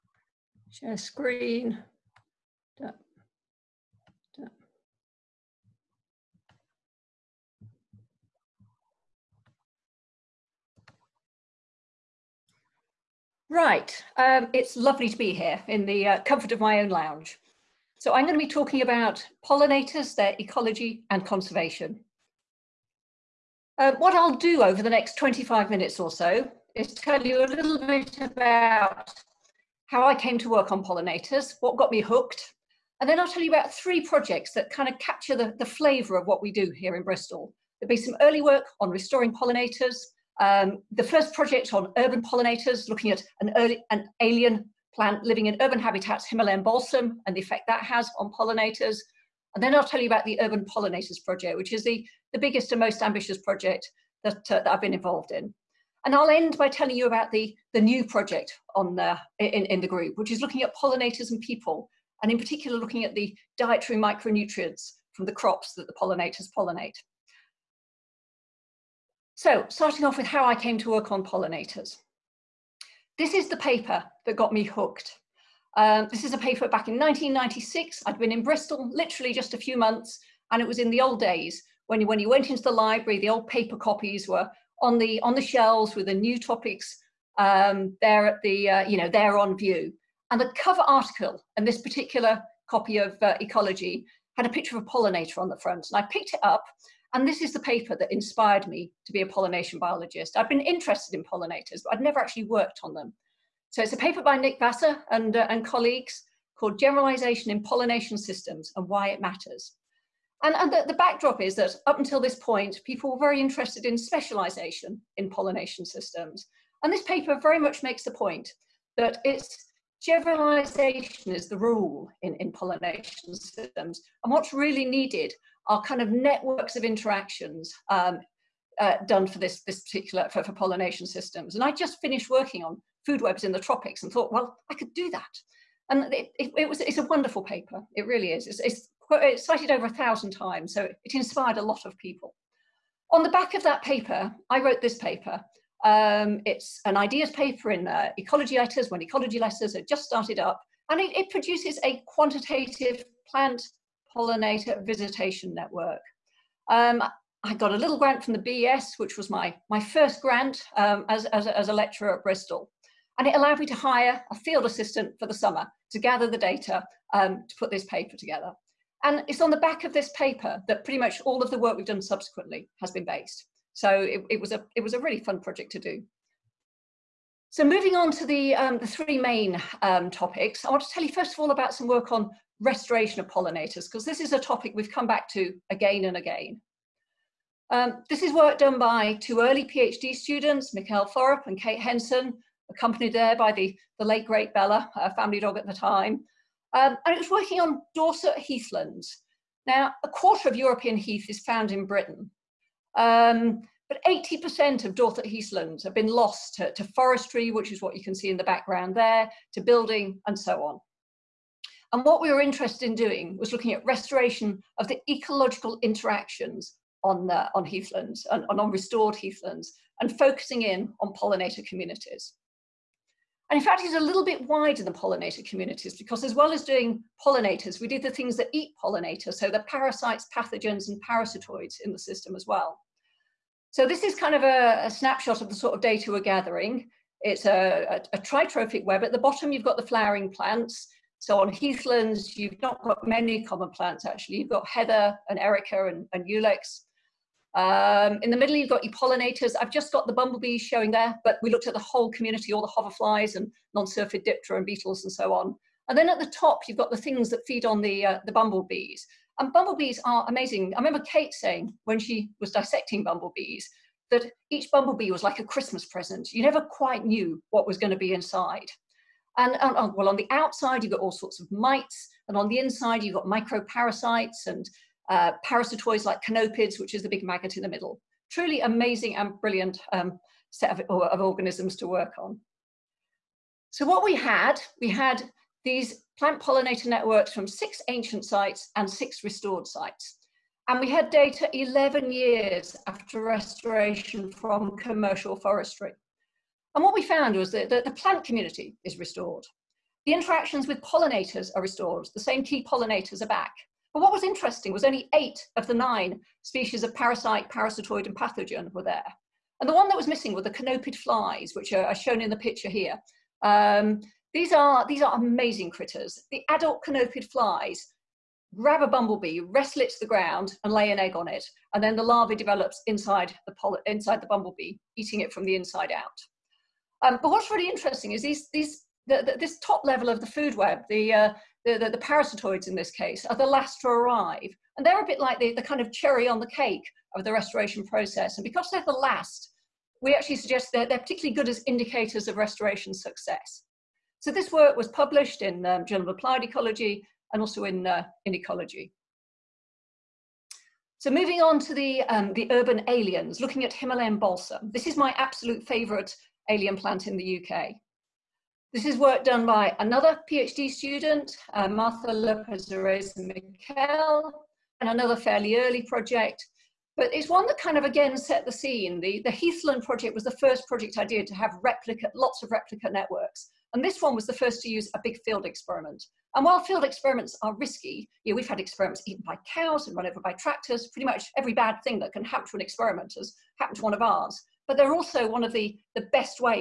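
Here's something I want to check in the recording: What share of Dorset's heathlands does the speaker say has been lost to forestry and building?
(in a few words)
80%.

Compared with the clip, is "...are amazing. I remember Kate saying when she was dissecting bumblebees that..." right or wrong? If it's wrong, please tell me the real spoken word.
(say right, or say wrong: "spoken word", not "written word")
right.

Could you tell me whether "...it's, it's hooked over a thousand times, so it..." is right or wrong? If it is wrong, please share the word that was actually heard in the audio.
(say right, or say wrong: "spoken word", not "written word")
wrong: "cited", not "hooked".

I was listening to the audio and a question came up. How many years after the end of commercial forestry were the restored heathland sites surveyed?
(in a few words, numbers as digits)
11.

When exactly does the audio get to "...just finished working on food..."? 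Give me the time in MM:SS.
02:11.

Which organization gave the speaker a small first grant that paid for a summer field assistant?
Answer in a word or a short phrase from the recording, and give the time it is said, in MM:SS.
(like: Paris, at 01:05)
BES, at 02:38.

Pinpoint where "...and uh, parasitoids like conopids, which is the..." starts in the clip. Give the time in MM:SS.
04:34.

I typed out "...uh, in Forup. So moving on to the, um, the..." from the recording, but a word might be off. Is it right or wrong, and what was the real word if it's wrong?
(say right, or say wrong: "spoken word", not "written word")
wrong: "Ecology", not "Forup".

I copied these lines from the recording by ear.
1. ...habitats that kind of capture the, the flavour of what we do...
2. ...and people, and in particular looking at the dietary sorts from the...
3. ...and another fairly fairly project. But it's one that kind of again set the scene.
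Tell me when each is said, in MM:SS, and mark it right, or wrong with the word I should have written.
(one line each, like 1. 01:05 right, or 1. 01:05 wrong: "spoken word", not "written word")
1. 00:34 wrong: "projects", not "habitats"
2. 01:01 wrong: "micronutrients", not "sorts"
3. 06:03 wrong: "early", not "fairly".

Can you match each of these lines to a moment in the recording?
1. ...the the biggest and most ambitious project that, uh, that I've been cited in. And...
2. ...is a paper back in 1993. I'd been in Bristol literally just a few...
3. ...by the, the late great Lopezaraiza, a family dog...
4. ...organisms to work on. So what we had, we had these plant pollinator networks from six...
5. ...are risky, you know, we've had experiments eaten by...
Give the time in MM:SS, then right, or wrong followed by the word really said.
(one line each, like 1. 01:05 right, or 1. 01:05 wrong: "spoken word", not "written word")
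1. 00:51 wrong: "involved", not "cited"
2. 01:16 wrong: "1996", not "1993"
3. 03:13 wrong: "Bella", not "Lopezaraiza"
4. 04:41 right
5. 06:17 right.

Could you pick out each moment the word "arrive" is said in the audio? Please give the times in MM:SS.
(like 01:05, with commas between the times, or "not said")
05:33.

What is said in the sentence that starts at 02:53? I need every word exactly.
So it, it was a it was a really fun project to do.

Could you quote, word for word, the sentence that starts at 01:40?
I've been interested in pollinators, but I'd never actually worked on them.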